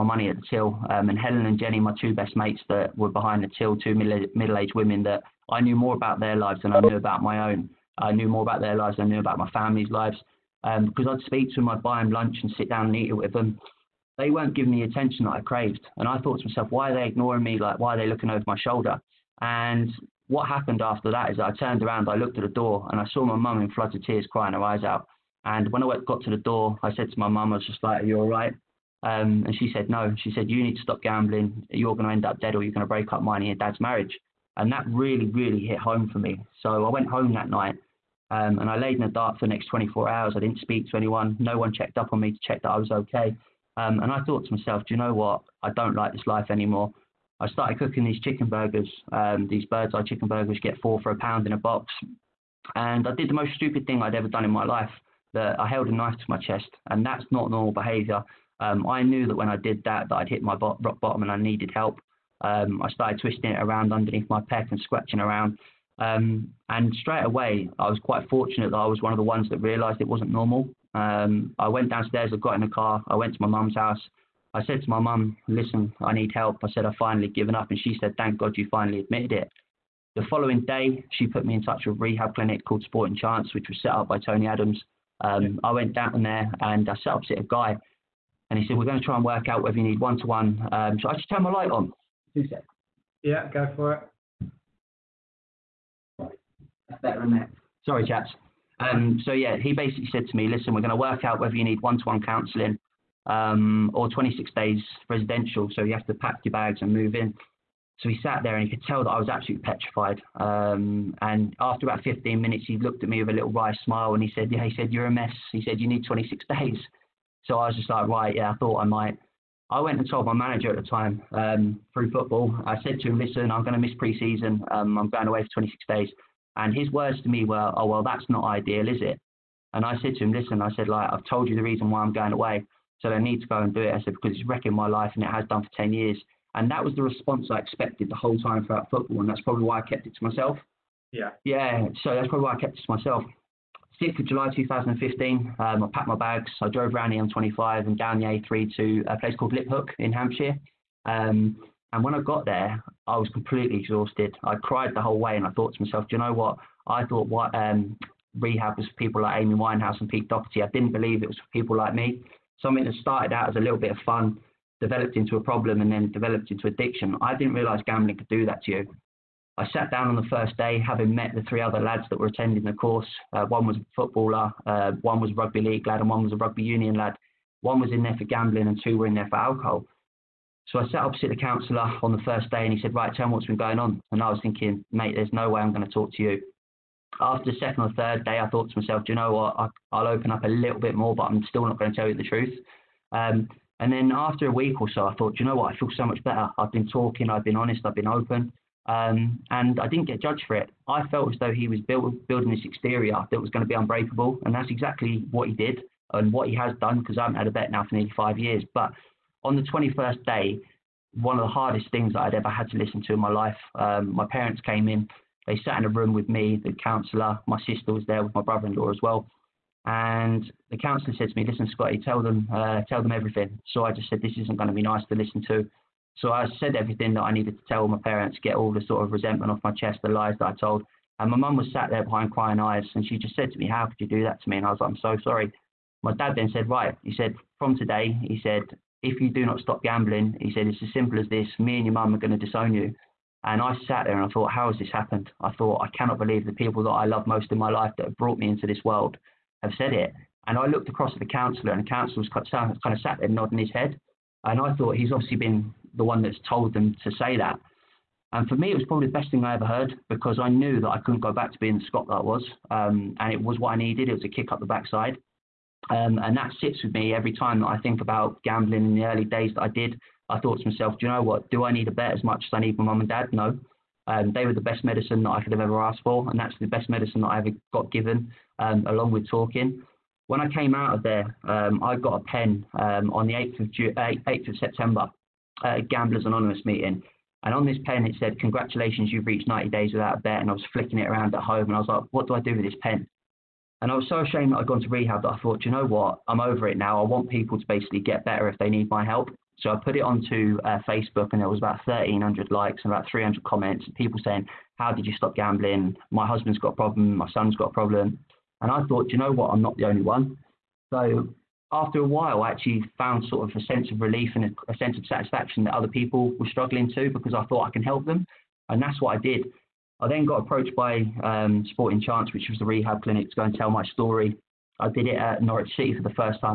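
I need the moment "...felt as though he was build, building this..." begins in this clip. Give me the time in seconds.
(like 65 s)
201 s.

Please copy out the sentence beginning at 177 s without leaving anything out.
One was in there for gambling, and two were in there for alcohol.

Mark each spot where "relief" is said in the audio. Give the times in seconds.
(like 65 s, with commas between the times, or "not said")
313 s.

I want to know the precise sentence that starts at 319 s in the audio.
I then got approached by um, Sporting Chance, which was the rehab clinic, to go and tell my story.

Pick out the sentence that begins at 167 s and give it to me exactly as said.
I didn't realize gambling could do that to you.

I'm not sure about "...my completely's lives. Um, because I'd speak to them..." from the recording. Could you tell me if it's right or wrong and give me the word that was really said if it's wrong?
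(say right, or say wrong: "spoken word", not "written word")
wrong: "family", not "completely".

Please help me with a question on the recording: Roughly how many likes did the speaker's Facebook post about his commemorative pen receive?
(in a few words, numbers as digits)
1,300.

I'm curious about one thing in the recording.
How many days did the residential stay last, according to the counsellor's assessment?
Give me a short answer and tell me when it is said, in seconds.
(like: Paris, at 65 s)
26, at 116 s.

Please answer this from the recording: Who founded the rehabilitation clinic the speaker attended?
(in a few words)
Tony Adams.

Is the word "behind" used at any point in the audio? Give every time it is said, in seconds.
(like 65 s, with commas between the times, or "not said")
3 s, 232 s.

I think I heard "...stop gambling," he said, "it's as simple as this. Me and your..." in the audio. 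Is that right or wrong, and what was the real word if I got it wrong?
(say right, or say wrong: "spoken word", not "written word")
right.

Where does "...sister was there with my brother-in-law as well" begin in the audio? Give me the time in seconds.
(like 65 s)
217 s.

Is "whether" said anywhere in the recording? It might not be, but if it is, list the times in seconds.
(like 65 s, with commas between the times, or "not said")
89 s, 101 s.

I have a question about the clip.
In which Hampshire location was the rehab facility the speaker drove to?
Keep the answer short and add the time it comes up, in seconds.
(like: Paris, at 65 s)
Liphook, at 149 s.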